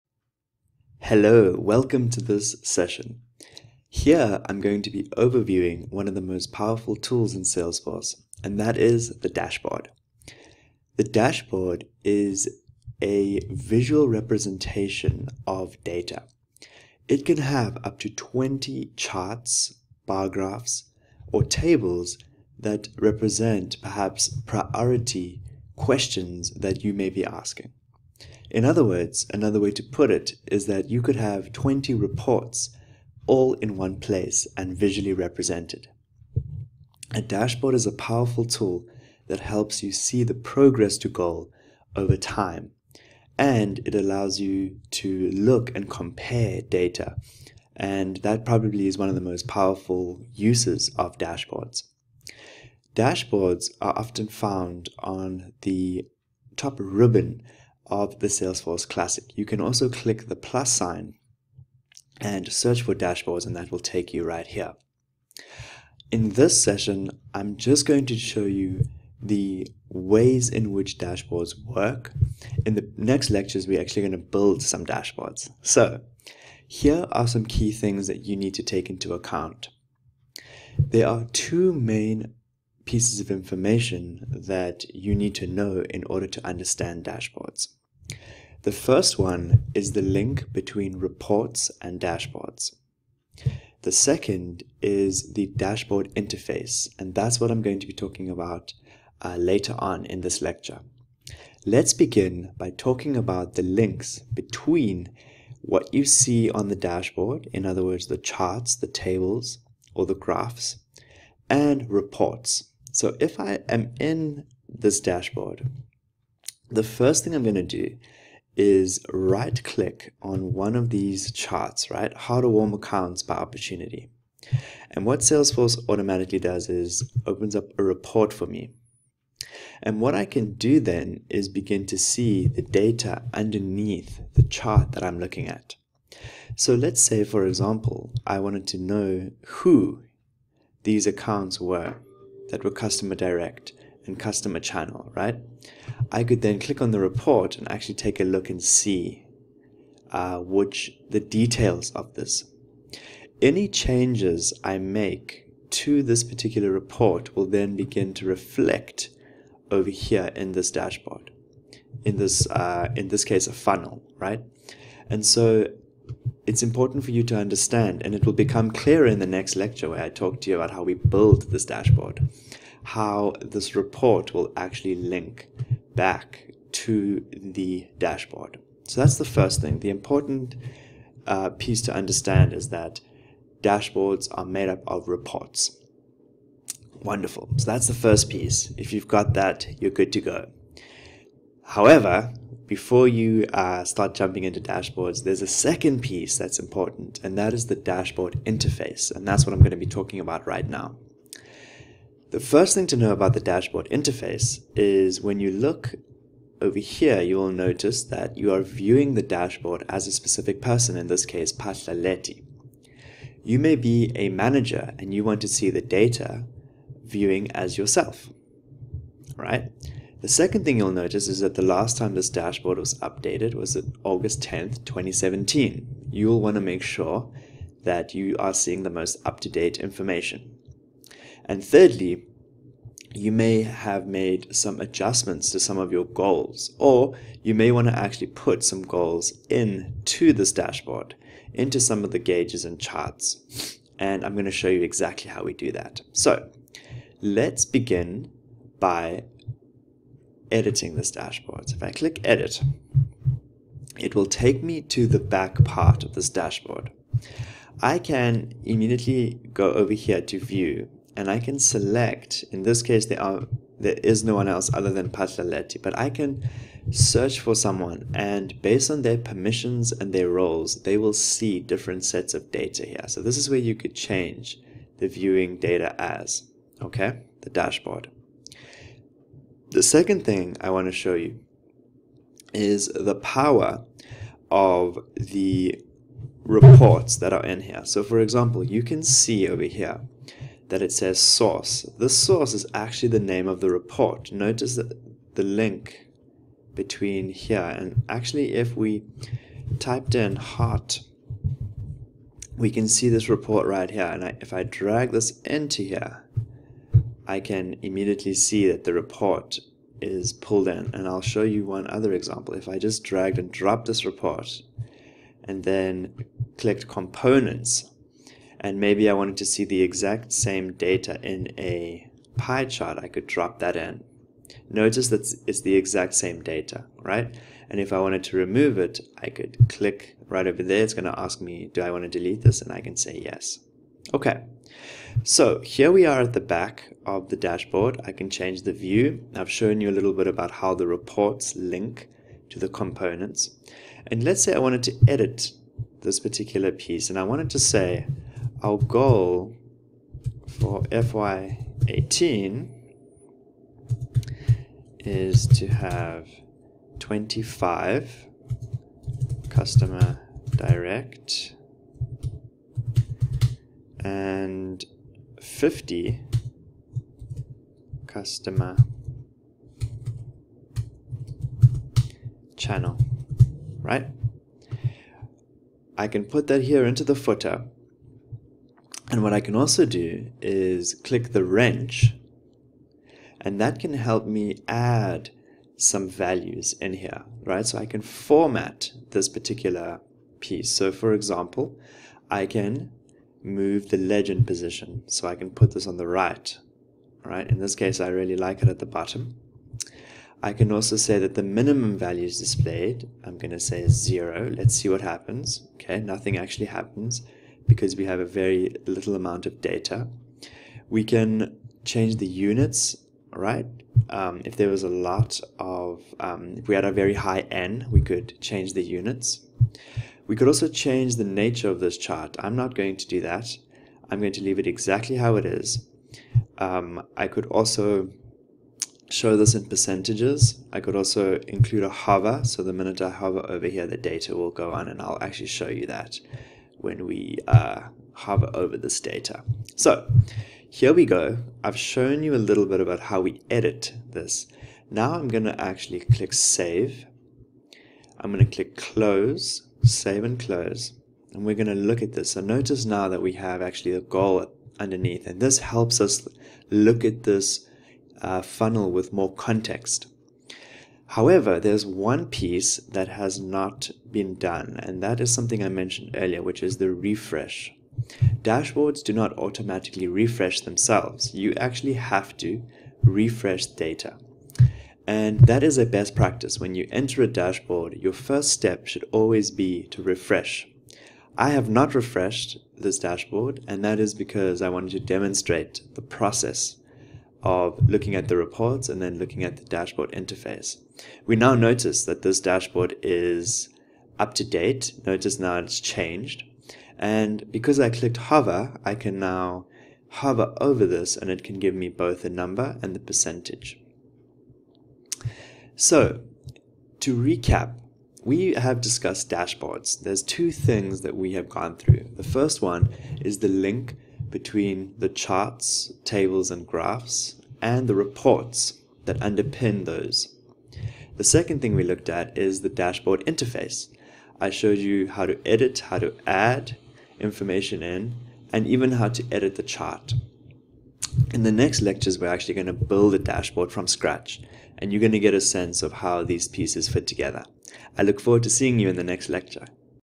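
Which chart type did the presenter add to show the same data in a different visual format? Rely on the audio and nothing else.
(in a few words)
pie chart.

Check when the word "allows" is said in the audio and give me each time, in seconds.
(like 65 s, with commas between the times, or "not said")
43 s.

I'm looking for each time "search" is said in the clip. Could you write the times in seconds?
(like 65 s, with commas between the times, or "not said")
62 s, 266 s.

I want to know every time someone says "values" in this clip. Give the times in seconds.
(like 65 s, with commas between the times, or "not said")
386 s, 401 s.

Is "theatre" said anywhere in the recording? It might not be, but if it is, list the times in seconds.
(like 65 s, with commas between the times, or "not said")
not said.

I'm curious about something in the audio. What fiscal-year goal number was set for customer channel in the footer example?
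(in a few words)
50.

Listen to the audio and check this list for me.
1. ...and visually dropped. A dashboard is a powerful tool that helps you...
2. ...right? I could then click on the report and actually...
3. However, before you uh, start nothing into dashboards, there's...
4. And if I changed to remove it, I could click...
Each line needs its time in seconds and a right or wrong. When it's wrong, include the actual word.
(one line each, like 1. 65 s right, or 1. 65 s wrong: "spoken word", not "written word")
1. 34 s wrong: "represented", not "dropped"
2. 145 s right
3. 191 s wrong: "jumping", not "nothing"
4. 327 s wrong: "wanted", not "changed".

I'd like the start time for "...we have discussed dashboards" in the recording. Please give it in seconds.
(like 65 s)
508 s.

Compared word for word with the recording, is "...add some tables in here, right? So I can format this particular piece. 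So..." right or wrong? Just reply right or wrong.
wrong.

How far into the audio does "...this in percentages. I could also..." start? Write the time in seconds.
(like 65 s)
429 s.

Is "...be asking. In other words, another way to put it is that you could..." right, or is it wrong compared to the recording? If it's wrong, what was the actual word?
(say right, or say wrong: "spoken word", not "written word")
right.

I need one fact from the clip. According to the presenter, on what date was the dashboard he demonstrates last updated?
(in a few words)
August 10th, 2017.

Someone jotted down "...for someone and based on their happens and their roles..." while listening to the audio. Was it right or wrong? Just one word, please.
wrong.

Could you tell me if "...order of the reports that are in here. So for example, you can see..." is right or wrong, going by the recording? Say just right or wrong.
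wrong.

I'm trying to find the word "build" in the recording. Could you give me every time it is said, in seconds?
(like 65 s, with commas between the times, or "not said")
74 s, 170 s, 532 s.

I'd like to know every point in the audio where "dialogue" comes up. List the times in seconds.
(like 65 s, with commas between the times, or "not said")
not said.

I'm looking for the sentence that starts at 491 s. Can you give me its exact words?
We now notice that this dashboard is up to date.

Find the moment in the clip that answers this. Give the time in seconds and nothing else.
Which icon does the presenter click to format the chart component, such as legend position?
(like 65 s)
381 s.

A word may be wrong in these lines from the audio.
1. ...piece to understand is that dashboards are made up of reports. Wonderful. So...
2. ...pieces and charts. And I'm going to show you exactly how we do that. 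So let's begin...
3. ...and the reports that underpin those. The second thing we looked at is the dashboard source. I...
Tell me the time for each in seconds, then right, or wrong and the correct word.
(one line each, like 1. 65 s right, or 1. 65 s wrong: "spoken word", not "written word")
1. 181 s right
2. 242 s wrong: "gauges", not "pieces"
3. 517 s wrong: "interface", not "source".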